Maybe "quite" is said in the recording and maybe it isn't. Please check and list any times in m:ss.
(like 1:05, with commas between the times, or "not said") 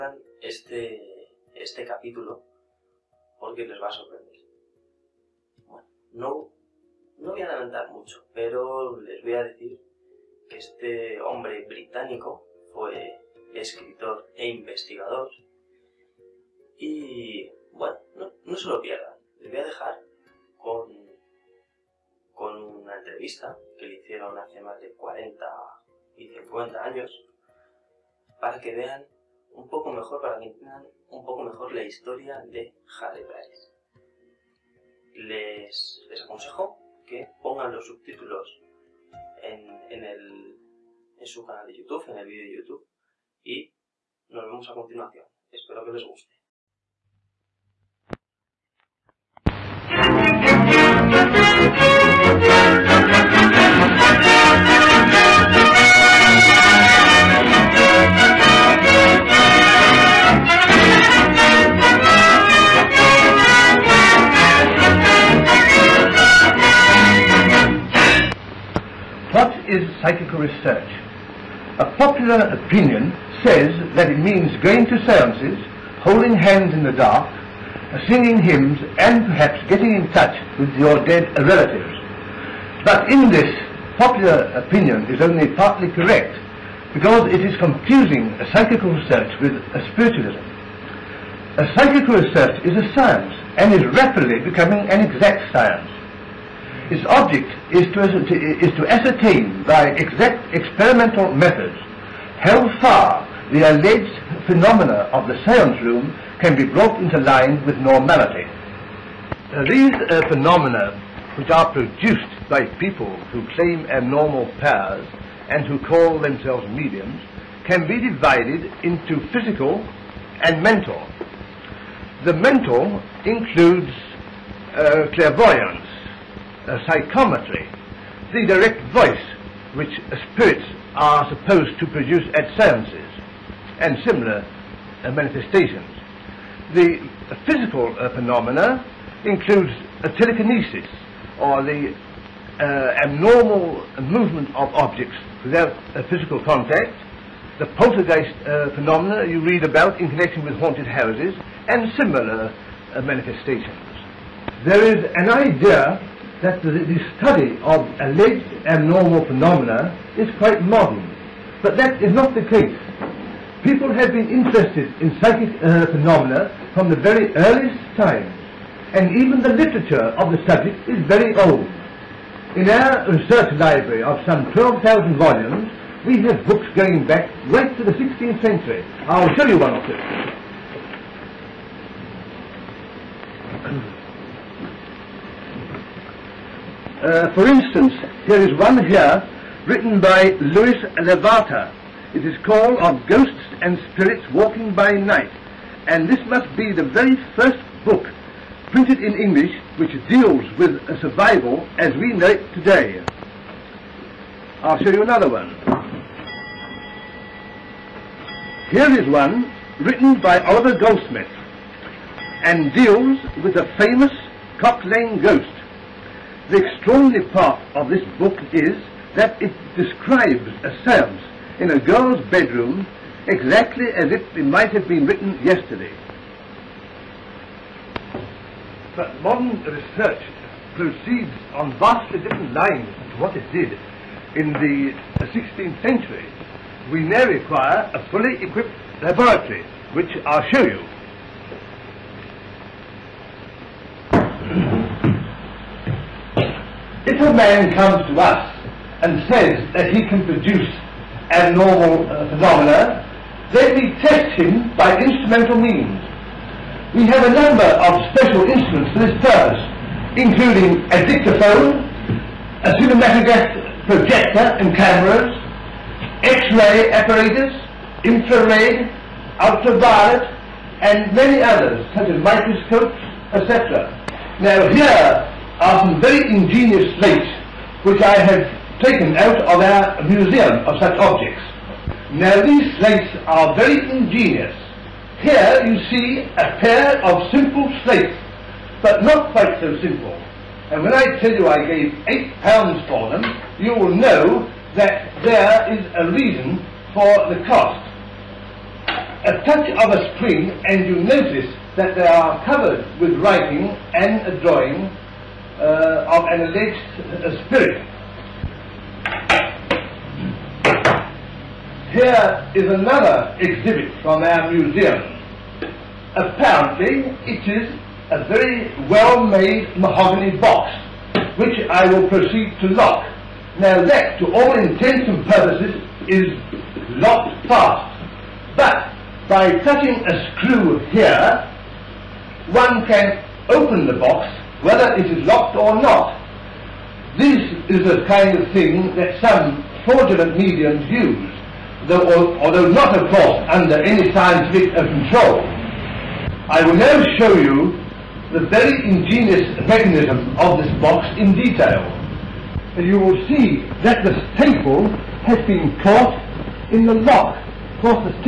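2:40, 4:49.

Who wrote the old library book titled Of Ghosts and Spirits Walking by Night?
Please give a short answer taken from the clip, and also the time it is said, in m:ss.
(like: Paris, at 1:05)
Louis Lavater, at 3:10.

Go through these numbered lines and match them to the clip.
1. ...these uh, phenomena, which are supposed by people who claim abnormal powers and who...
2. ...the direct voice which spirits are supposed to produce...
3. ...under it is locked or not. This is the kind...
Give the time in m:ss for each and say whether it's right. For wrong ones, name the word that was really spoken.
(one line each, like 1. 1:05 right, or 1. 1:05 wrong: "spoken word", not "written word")
1. 1:49 wrong: "produced", not "supposed"
2. 2:08 right
3. 5:34 wrong: "whether", not "under".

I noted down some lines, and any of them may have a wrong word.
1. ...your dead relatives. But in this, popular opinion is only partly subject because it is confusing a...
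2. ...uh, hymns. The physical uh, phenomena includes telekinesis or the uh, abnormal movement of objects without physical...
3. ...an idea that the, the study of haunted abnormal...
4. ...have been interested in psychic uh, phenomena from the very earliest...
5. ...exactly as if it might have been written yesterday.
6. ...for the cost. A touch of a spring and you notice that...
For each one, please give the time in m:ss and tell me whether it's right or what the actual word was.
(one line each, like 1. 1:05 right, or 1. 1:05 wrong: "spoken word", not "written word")
1. 1:20 wrong: "correct", not "subject"
2. 2:15 wrong: "manifestations", not "hymns"
3. 2:35 wrong: "alleged", not "haunted"
4. 2:43 right
5. 3:43 right
6. 4:56 right.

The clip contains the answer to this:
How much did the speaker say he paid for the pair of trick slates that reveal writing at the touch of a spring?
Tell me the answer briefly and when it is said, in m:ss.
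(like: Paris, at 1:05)
8 pounds, at 4:52.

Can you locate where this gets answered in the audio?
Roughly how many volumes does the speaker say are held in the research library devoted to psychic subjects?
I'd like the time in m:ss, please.
2:54.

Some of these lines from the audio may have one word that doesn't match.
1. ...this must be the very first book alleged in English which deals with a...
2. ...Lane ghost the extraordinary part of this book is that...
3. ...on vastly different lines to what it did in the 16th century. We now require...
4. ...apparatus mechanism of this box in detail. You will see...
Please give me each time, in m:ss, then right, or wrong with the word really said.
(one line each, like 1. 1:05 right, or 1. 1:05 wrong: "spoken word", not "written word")
1. 3:16 wrong: "printed", not "alleged"
2. 3:34 right
3. 3:51 right
4. 5:48 wrong: "ingenious", not "apparatus".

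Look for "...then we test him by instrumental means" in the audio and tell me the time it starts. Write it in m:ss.
4:13.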